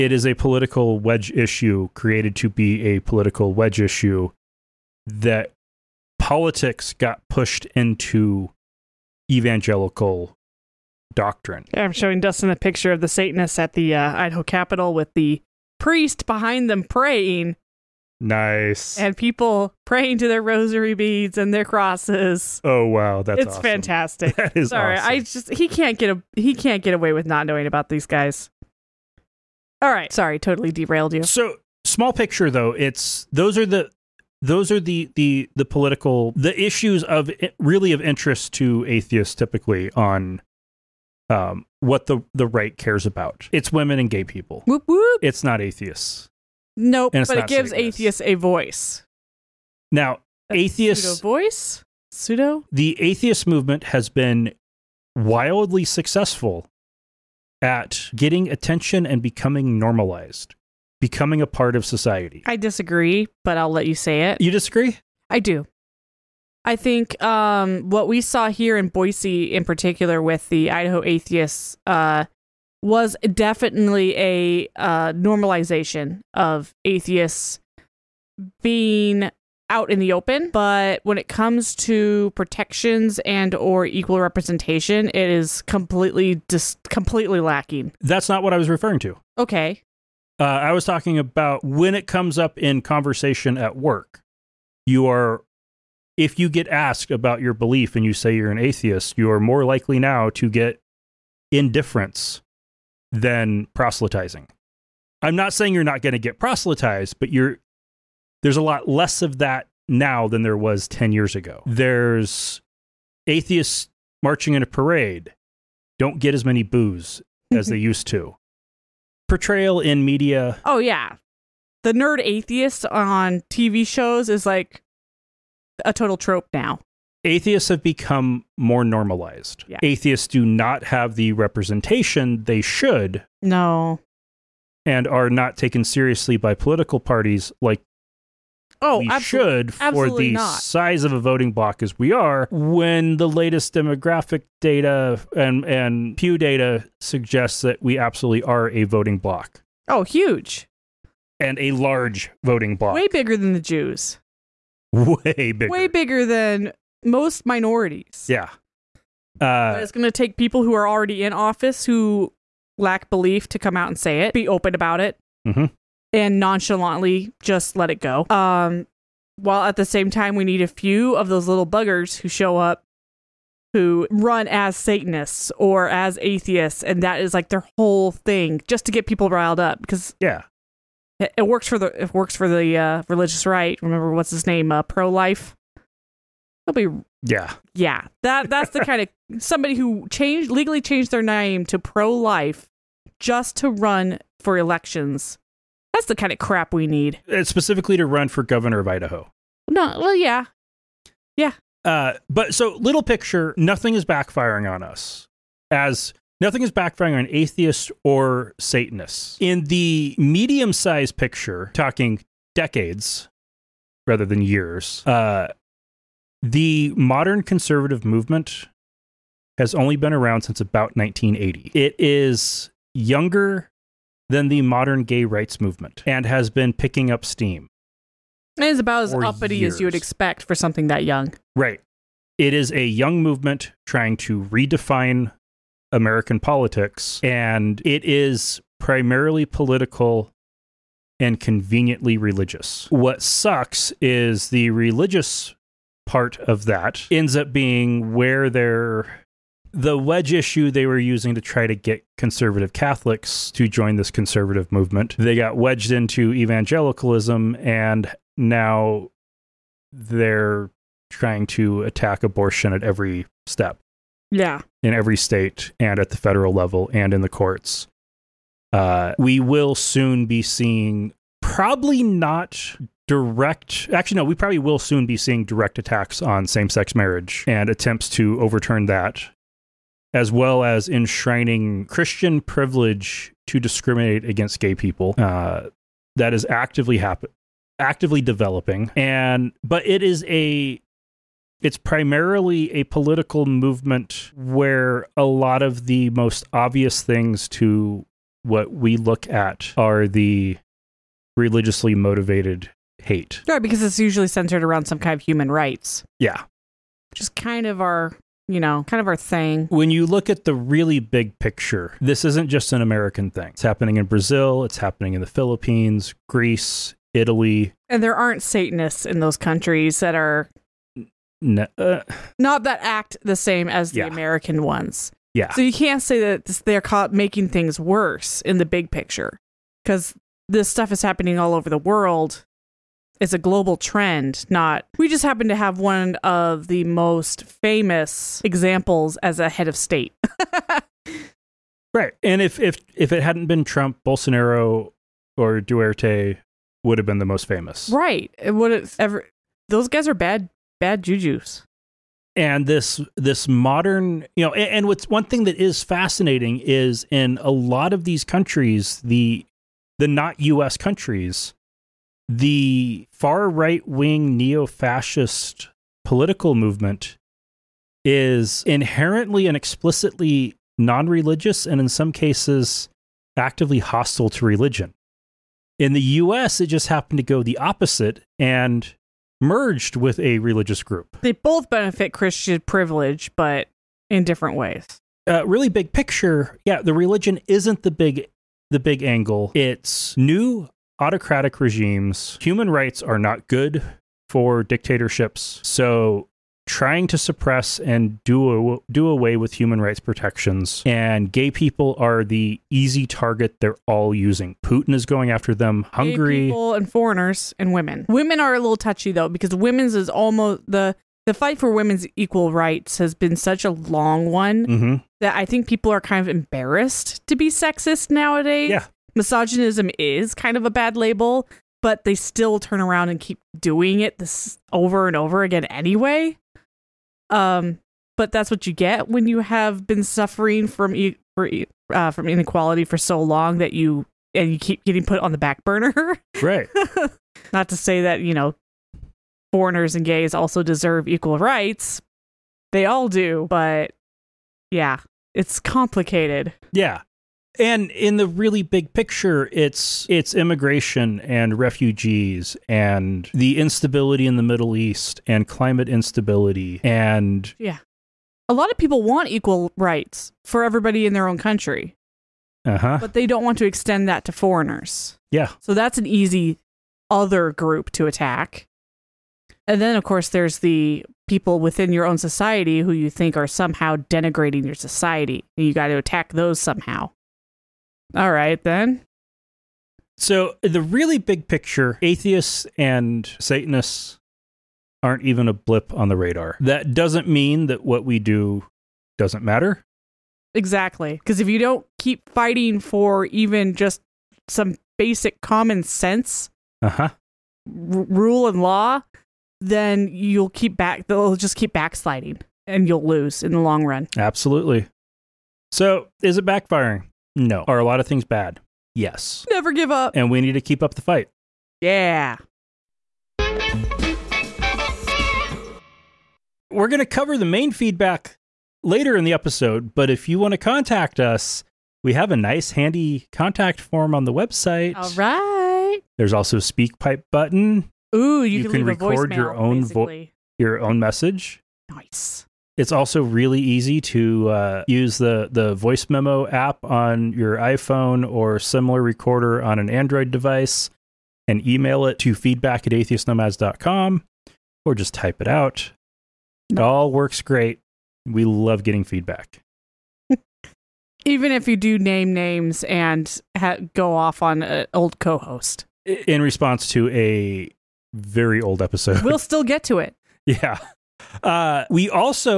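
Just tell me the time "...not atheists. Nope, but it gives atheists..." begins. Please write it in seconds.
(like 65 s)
45 s.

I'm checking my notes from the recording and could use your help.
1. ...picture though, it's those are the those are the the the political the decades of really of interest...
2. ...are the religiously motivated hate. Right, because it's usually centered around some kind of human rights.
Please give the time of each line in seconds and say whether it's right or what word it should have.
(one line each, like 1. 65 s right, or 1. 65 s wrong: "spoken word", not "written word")
1. 32 s wrong: "issues", not "decades"
2. 299 s right.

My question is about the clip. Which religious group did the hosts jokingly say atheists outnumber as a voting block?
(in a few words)
Jews.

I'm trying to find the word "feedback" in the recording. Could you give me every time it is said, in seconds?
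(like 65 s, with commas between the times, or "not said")
517 s, 542 s, 549 s.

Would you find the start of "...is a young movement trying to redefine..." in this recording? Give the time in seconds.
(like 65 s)
232 s.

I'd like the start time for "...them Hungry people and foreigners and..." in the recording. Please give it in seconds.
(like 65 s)
405 s.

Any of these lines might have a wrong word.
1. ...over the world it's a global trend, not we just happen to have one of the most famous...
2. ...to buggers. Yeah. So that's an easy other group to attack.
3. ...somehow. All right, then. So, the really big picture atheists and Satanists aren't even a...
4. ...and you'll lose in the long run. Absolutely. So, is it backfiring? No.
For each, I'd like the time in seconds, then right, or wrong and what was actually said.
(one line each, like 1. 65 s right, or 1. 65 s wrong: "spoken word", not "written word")
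1. 331 s right
2. 464 s wrong: "foreigners", not "buggers"
3. 476 s right
4. 502 s right.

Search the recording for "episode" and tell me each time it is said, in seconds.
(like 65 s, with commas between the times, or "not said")
519 s, 558 s.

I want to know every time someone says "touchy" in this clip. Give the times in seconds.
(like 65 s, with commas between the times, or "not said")
408 s.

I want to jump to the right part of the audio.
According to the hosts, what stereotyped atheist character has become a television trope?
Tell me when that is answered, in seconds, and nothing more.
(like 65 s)
121 s.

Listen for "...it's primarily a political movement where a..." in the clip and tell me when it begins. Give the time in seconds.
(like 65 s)
291 s.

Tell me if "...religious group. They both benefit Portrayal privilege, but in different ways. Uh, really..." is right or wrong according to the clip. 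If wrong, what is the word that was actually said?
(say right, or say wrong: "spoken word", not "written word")
wrong: "Christian", not "Portrayal".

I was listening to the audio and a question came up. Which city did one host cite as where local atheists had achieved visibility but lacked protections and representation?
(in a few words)
Boise.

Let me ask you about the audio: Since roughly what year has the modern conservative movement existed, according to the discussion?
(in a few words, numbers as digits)
1980.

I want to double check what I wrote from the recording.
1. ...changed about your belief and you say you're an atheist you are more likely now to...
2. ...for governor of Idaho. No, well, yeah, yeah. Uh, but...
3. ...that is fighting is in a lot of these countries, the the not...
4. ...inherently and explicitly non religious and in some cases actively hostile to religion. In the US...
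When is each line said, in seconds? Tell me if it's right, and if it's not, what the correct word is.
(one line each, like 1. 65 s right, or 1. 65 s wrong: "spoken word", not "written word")
1. 96 s wrong: "asked", not "changed"
2. 198 s right
3. 355 s wrong: "fascinating", not "fighting"
4. 368 s right.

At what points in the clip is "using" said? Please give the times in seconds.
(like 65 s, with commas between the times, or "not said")
250 s, 404 s.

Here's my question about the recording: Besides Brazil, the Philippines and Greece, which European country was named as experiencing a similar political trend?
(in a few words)
Italy.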